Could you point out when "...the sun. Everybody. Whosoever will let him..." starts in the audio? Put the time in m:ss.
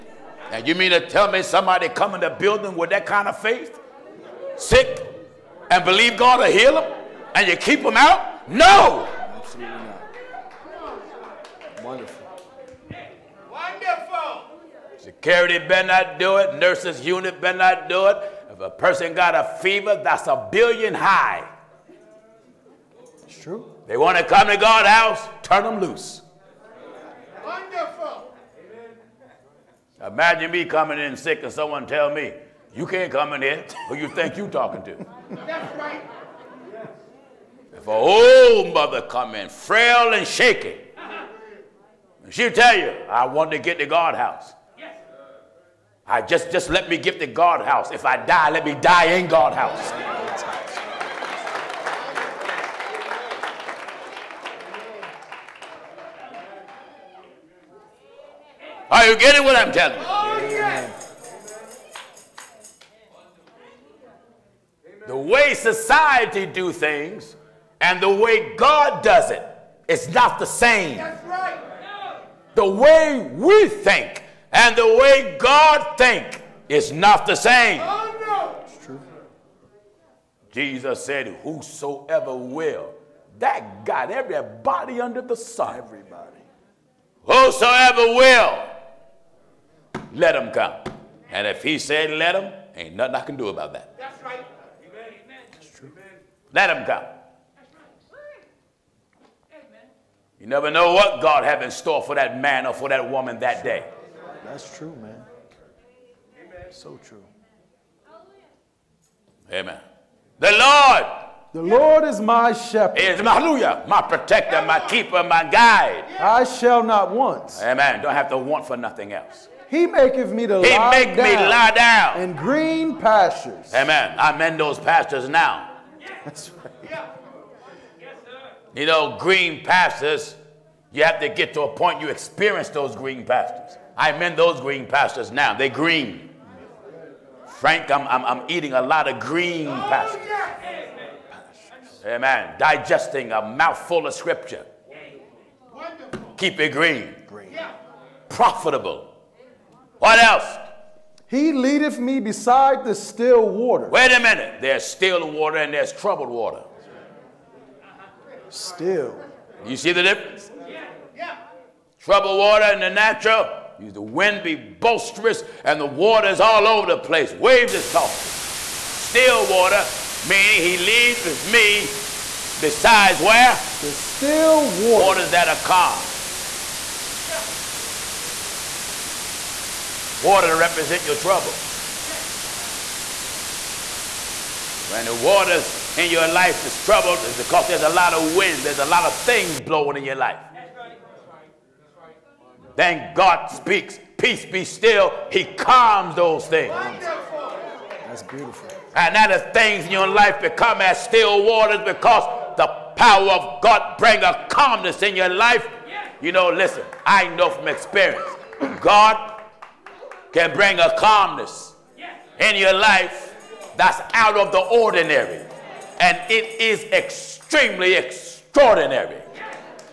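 1:25.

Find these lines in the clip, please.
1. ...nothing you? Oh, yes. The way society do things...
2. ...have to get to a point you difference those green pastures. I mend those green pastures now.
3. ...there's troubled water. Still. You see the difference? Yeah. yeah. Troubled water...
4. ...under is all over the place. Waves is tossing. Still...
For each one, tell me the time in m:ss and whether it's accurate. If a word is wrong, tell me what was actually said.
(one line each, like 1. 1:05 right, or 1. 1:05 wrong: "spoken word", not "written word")
1. 0:59 wrong: "telling", not "nothing"
2. 2:11 wrong: "experience", not "difference"
3. 2:35 right
4. 2:45 wrong: "water", not "under".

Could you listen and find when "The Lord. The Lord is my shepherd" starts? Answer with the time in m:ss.
1:50.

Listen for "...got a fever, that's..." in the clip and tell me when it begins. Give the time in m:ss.
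0:19.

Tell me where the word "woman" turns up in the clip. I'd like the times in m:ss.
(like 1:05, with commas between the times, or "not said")
1:43.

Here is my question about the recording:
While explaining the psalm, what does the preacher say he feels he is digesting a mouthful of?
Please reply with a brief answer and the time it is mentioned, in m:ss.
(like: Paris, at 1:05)
Scripture, at 2:24.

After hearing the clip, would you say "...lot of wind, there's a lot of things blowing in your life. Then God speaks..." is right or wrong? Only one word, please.
right.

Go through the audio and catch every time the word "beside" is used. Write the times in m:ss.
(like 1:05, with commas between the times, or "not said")
2:32, 2:52.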